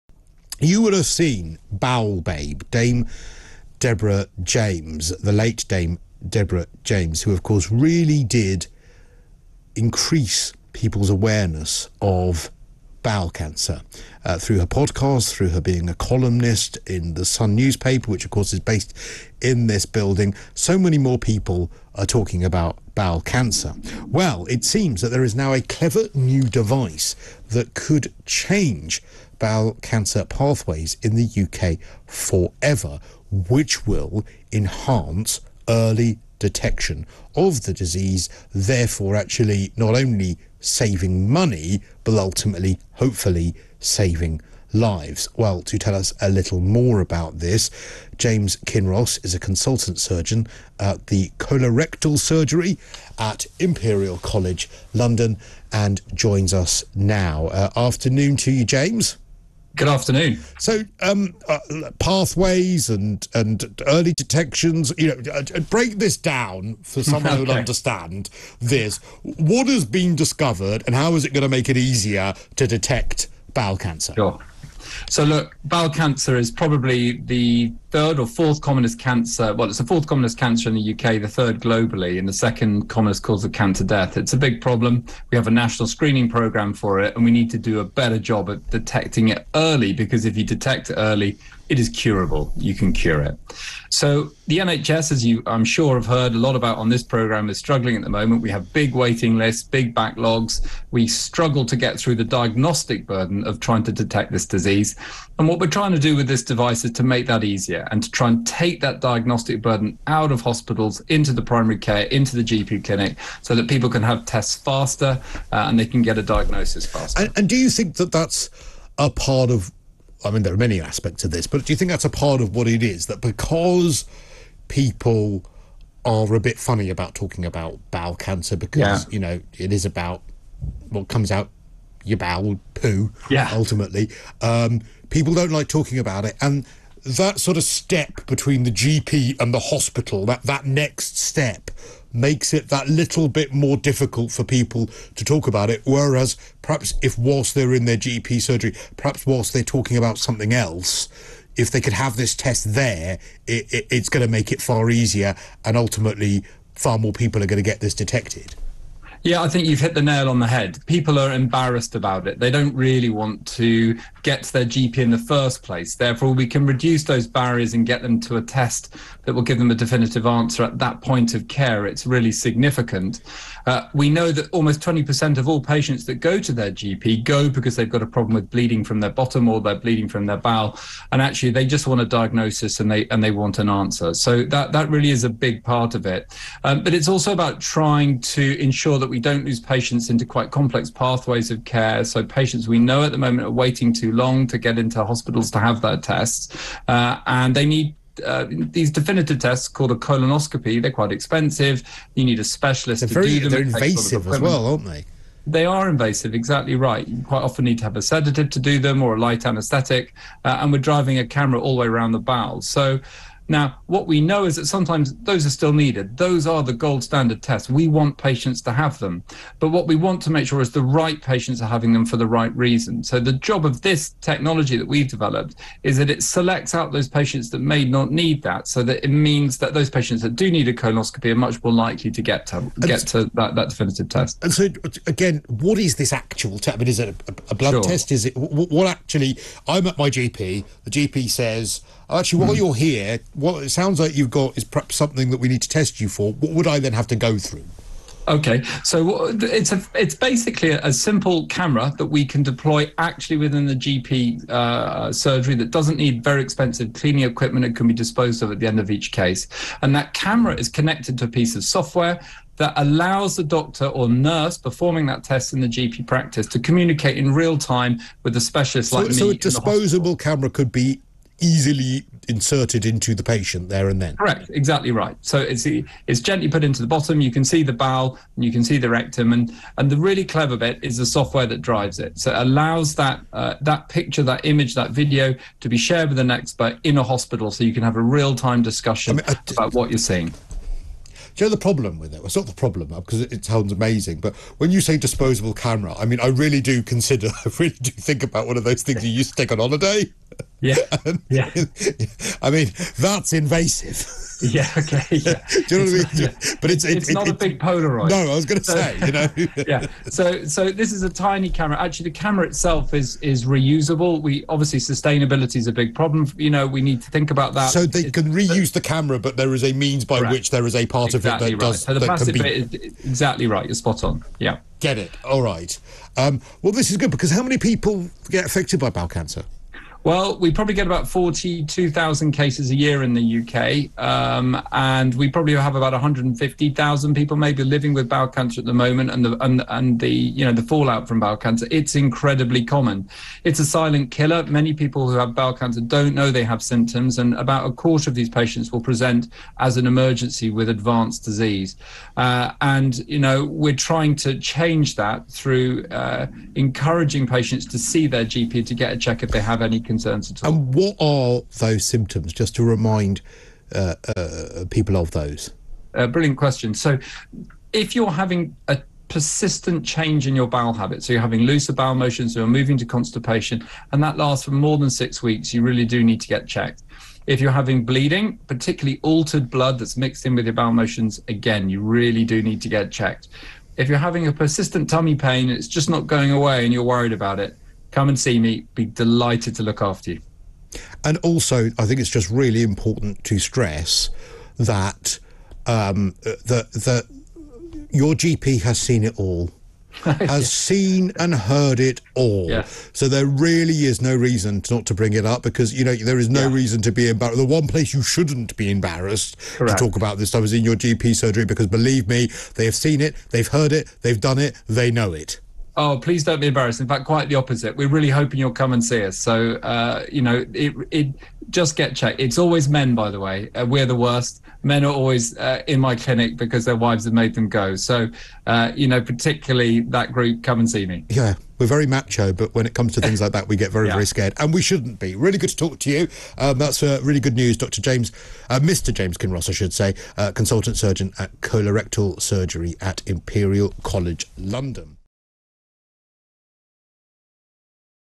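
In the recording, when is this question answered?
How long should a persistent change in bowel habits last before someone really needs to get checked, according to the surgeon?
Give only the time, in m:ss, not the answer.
6:14.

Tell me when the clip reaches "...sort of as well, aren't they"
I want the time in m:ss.
3:24.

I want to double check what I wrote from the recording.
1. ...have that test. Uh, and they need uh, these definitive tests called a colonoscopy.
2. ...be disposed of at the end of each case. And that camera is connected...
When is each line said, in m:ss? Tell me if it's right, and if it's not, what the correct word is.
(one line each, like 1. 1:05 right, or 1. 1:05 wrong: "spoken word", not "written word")
1. 3:15 right
2. 4:17 right.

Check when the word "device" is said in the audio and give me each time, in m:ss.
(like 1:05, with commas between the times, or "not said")
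0:26, 1:46.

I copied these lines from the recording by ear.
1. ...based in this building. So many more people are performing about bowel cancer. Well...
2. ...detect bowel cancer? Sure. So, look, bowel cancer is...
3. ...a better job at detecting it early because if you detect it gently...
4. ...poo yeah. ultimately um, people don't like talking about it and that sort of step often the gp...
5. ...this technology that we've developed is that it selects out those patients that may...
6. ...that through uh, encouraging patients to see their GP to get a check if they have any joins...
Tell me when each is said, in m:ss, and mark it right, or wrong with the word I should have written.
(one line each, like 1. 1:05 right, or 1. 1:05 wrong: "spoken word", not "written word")
1. 0:18 wrong: "talking", not "performing"
2. 1:12 right
3. 1:27 wrong: "early", not "gently"
4. 2:12 wrong: "between", not "often"
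5. 3:43 right
6. 5:54 wrong: "concerns", not "joins".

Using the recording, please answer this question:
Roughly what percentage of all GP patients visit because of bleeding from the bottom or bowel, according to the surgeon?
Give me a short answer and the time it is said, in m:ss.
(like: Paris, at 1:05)
20%, at 2:54.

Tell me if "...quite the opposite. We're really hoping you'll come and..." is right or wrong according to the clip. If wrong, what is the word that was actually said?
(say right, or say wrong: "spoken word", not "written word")
right.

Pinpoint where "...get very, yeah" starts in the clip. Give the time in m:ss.
7:13.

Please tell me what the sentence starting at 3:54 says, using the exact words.
And so, again, what is this actual test?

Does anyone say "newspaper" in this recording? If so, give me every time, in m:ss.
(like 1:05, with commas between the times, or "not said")
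0:17.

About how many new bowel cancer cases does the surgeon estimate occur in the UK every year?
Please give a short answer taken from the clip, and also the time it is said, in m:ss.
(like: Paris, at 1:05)
42,000, at 5:31.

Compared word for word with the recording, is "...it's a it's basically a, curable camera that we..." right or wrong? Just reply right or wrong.
wrong.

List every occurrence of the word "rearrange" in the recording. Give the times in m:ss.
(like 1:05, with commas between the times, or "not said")
not said.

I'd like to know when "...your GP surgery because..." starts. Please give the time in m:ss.
6:50.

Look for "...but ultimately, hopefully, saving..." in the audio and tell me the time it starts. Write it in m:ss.
0:42.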